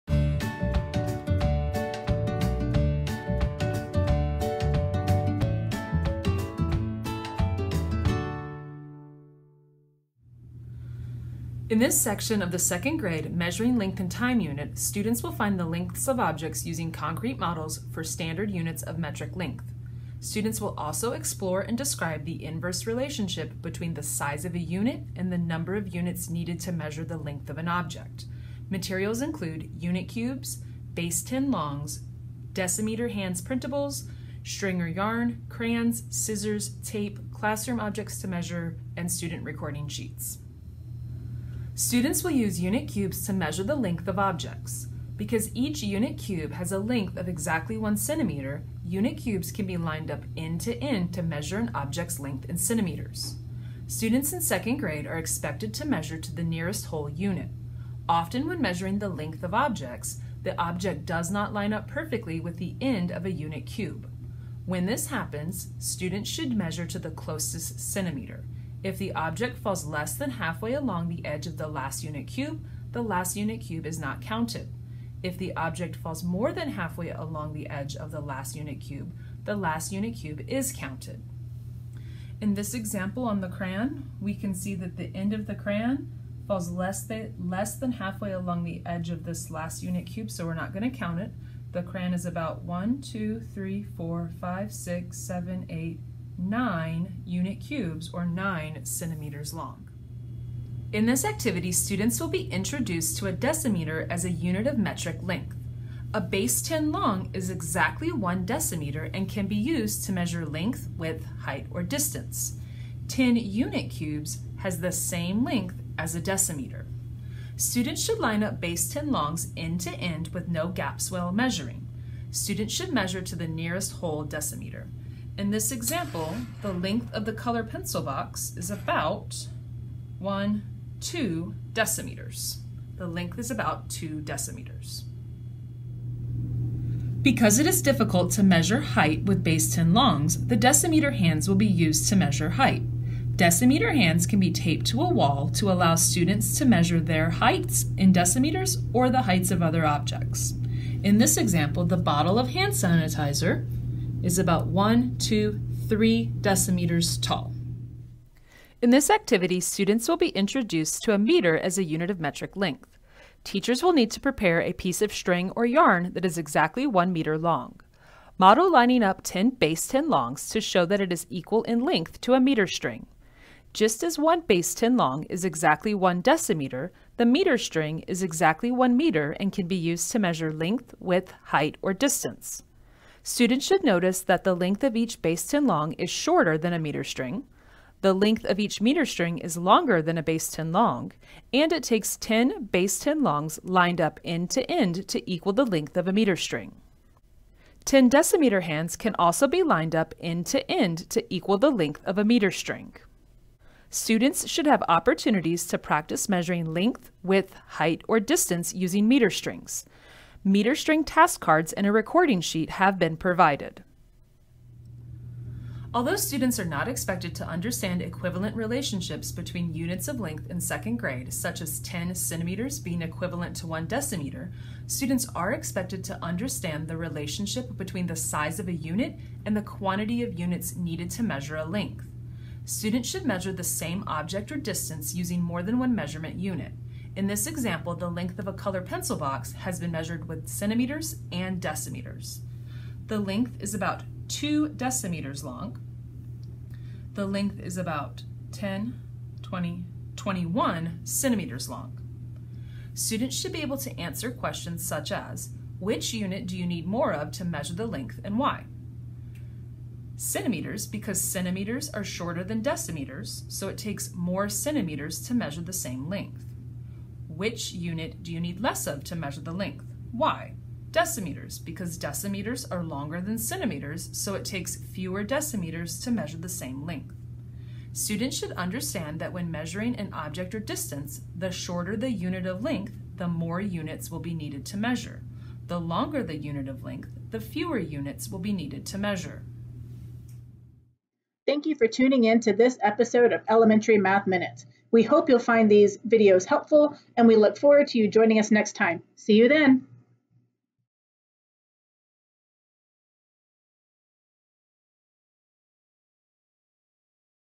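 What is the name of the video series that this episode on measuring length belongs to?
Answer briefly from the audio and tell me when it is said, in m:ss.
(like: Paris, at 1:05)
Elementary Math Minute, at 4:53.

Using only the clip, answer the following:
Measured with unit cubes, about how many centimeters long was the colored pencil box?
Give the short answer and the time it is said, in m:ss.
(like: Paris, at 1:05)
21, at 4:10.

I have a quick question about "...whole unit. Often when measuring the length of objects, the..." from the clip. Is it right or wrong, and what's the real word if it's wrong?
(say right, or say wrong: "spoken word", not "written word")
right.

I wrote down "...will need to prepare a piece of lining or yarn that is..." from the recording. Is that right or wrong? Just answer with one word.
wrong.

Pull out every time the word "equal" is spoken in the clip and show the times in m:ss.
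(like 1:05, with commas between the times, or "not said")
2:51, 3:15, 3:21.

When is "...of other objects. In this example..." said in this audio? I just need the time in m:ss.
2:29.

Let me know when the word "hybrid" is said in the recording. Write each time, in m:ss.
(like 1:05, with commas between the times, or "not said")
not said.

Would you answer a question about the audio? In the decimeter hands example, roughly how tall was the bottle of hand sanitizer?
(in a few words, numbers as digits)
3 decimeters.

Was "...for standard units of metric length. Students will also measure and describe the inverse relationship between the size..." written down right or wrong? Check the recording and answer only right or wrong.
wrong.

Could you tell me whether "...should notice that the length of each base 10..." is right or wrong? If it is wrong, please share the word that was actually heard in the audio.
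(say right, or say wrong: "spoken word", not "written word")
right.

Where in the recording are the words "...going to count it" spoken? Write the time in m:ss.
1:30.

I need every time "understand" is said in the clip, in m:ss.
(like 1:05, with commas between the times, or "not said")
3:37, 3:46, 4:38.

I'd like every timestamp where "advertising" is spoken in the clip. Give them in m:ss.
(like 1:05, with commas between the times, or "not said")
not said.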